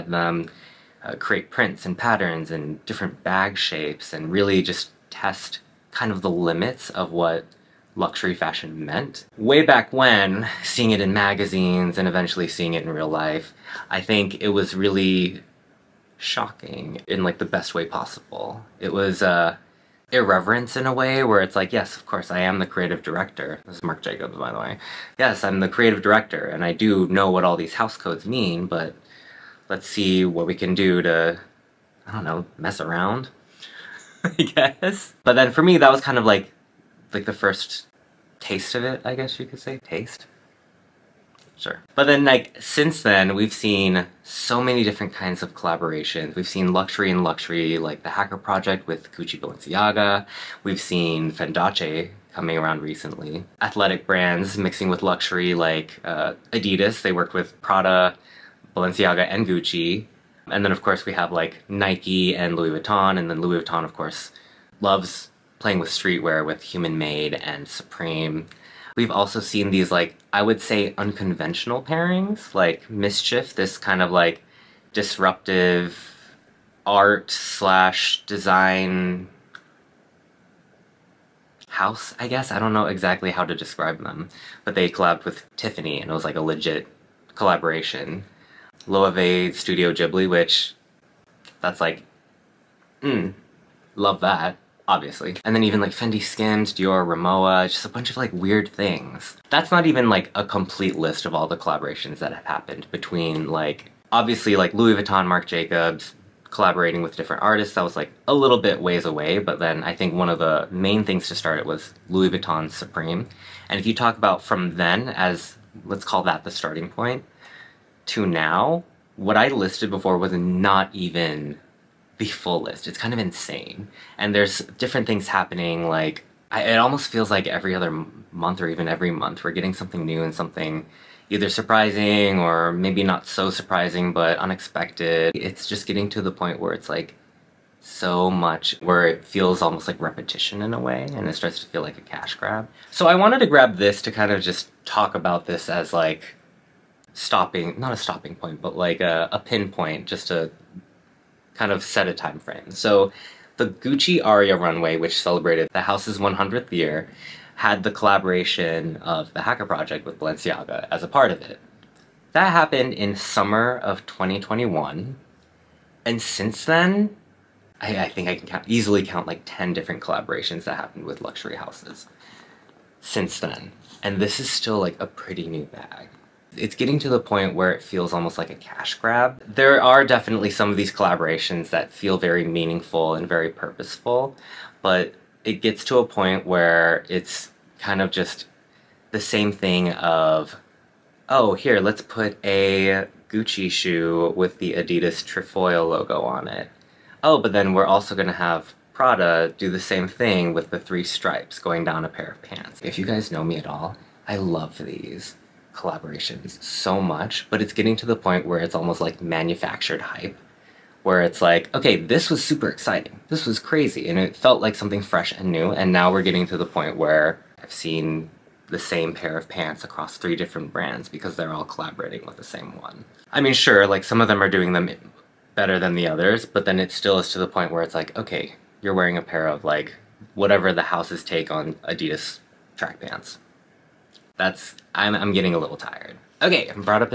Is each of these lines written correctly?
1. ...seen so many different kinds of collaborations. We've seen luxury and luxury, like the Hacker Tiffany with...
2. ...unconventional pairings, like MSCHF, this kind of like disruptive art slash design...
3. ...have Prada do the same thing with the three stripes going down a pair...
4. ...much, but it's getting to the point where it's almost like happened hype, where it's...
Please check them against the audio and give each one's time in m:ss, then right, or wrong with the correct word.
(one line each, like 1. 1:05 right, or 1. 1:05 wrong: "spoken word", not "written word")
1. 0:43 wrong: "Project", not "Tiffany"
2. 1:10 right
3. 3:18 right
4. 3:27 wrong: "manufactured", not "happened".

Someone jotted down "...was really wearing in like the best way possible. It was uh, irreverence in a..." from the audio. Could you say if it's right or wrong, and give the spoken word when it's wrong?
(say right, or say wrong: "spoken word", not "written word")
wrong: "shocking", not "wearing".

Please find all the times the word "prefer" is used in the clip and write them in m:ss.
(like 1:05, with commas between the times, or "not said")
not said.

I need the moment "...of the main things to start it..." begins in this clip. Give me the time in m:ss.
1:50.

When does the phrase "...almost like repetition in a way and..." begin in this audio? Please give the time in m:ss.
2:19.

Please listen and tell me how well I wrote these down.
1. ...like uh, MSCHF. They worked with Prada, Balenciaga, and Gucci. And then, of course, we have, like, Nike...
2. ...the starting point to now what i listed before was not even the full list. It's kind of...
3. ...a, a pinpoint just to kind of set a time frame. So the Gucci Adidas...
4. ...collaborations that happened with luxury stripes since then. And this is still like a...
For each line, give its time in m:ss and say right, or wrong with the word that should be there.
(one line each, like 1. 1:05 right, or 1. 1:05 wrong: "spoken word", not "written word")
1. 0:55 wrong: "Adidas", not "MSCHF"
2. 1:56 right
3. 2:29 wrong: "Aria", not "Adidas"
4. 2:50 wrong: "houses", not "stripes".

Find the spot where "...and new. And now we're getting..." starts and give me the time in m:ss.
3:35.